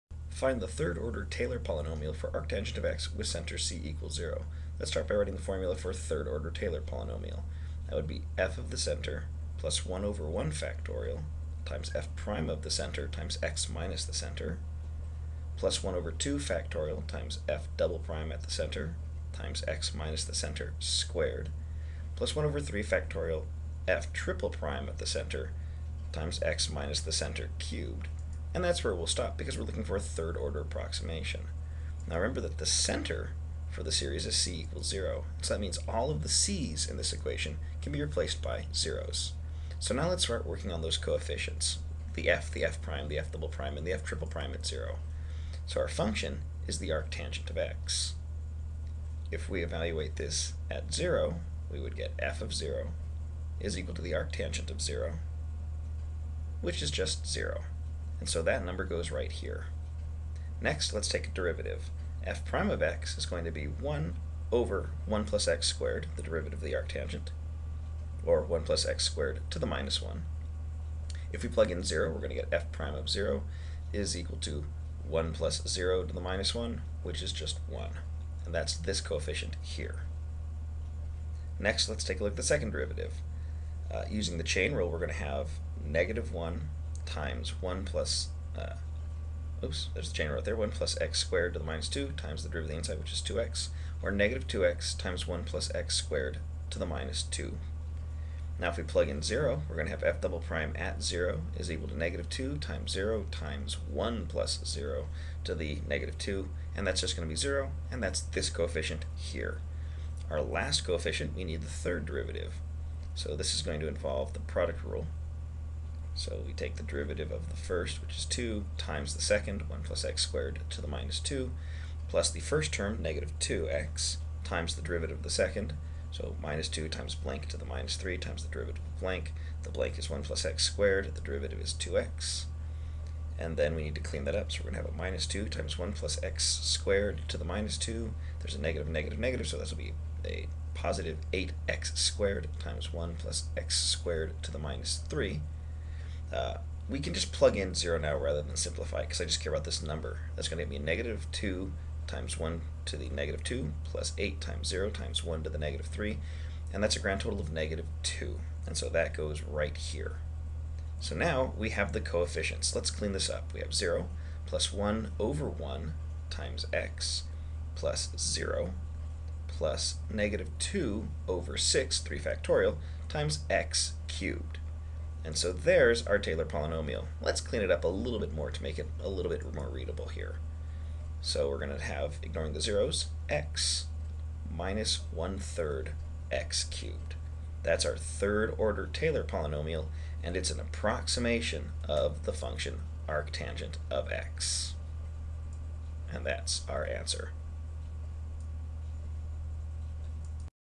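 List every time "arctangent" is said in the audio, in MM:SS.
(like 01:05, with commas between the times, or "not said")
00:02, 00:46, 00:54, 01:06, 03:13.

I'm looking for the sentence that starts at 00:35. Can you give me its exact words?
So that means all of the c's in this equation can be replaced by zeros.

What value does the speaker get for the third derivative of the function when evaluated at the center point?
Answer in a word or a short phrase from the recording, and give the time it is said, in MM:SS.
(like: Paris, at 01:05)
-2, at 02:36.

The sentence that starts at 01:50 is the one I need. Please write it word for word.
Our last coefficient, we need the third derivative.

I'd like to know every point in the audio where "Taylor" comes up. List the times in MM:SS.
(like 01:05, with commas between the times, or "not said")
00:01, 00:06, 02:56, 03:08.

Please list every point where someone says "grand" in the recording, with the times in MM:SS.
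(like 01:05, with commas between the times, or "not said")
02:36.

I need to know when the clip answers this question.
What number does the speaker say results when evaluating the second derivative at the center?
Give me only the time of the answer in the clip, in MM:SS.
01:46.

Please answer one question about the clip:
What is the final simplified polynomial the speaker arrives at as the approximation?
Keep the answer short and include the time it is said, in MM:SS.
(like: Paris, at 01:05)
x - 1/3 x^3, at 03:03.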